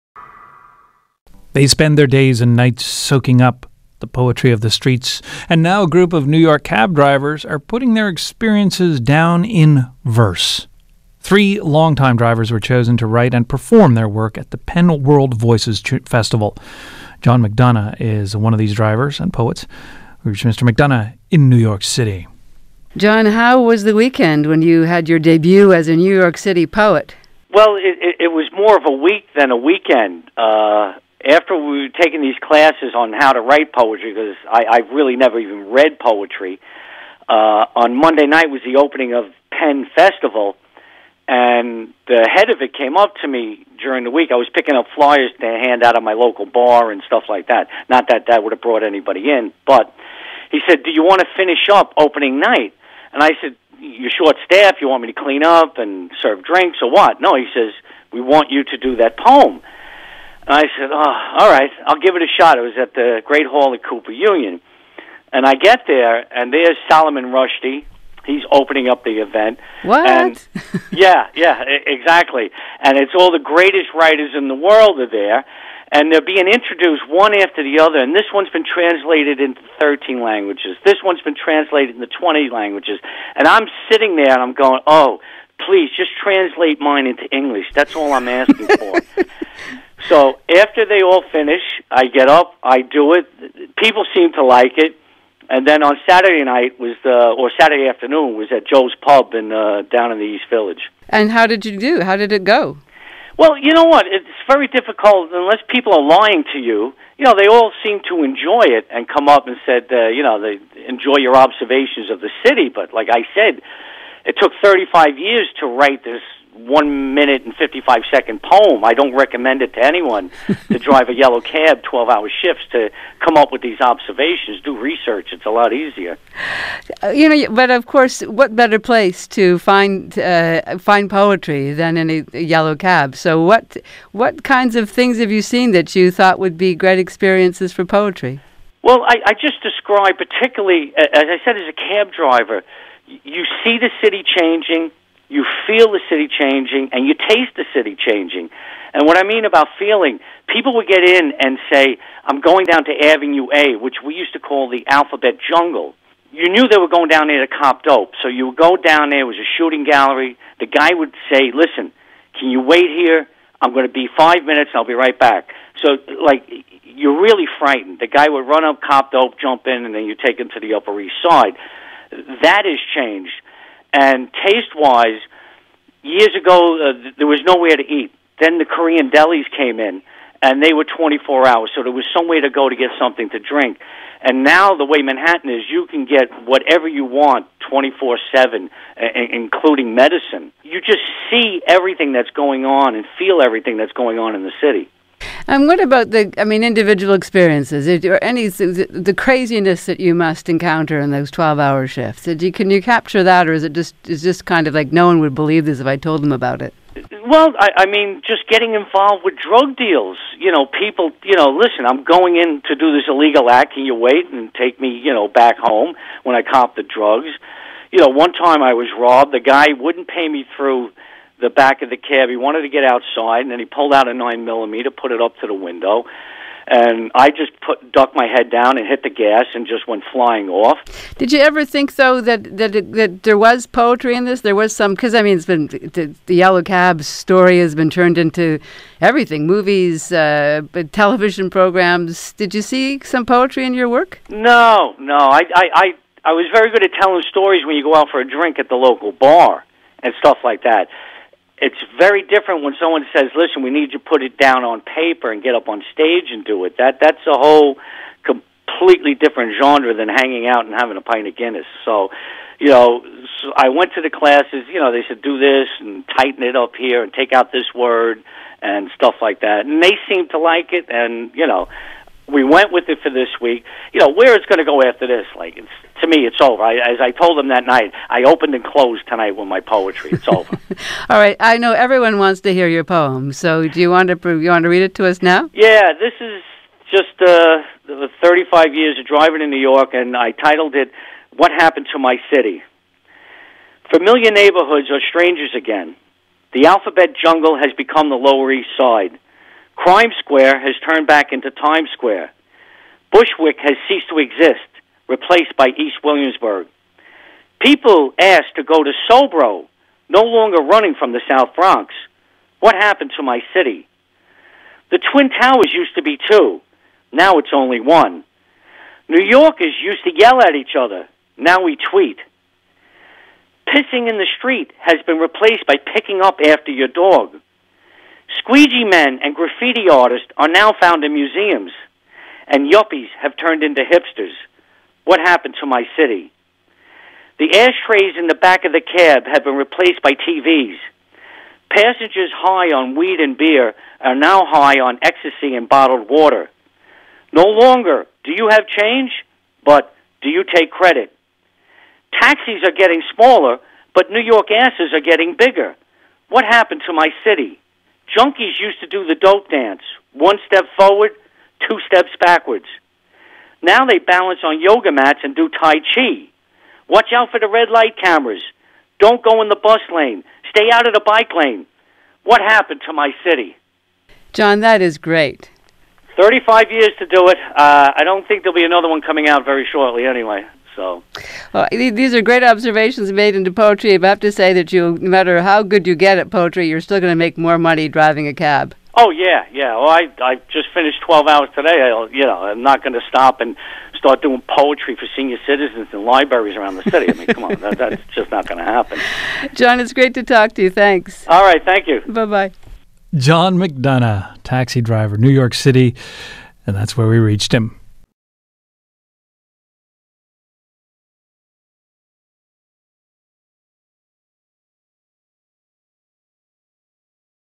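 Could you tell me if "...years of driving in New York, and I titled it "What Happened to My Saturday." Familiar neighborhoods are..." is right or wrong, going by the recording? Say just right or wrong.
wrong.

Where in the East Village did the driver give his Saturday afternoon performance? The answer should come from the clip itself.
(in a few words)
Joe's Pub.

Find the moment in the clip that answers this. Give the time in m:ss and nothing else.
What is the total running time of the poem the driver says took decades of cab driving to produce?
1:56.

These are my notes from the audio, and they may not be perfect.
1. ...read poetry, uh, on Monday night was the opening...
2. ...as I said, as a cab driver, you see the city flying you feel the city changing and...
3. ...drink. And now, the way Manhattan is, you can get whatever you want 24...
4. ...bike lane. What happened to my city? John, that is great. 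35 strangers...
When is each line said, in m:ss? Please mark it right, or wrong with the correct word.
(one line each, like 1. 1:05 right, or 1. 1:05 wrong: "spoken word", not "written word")
1. 0:35 right
2. 2:20 wrong: "changing", not "flying"
3. 3:03 right
4. 6:11 wrong: "years", not "strangers".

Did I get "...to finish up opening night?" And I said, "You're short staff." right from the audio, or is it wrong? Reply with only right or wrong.
right.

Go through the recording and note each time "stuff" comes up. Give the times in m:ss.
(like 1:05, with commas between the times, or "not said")
0:47, 4:10, 4:28.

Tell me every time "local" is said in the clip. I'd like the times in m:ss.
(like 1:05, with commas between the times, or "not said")
0:46, 4:08.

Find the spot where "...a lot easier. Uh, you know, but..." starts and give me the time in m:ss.
2:05.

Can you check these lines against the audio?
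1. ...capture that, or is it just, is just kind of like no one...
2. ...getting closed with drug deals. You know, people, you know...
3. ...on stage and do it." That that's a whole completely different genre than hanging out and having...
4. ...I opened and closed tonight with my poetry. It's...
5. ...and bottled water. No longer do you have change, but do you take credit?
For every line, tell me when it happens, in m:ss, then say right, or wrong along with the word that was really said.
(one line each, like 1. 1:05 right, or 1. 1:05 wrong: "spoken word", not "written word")
1. 3:22 right
2. 3:28 wrong: "involved", not "closed"
3. 4:15 right
4. 4:38 right
5. 5:45 right.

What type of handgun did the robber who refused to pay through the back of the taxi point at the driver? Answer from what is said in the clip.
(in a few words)
nine millimeter.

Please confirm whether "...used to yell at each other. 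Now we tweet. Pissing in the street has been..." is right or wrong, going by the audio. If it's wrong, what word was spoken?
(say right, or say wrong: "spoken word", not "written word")
right.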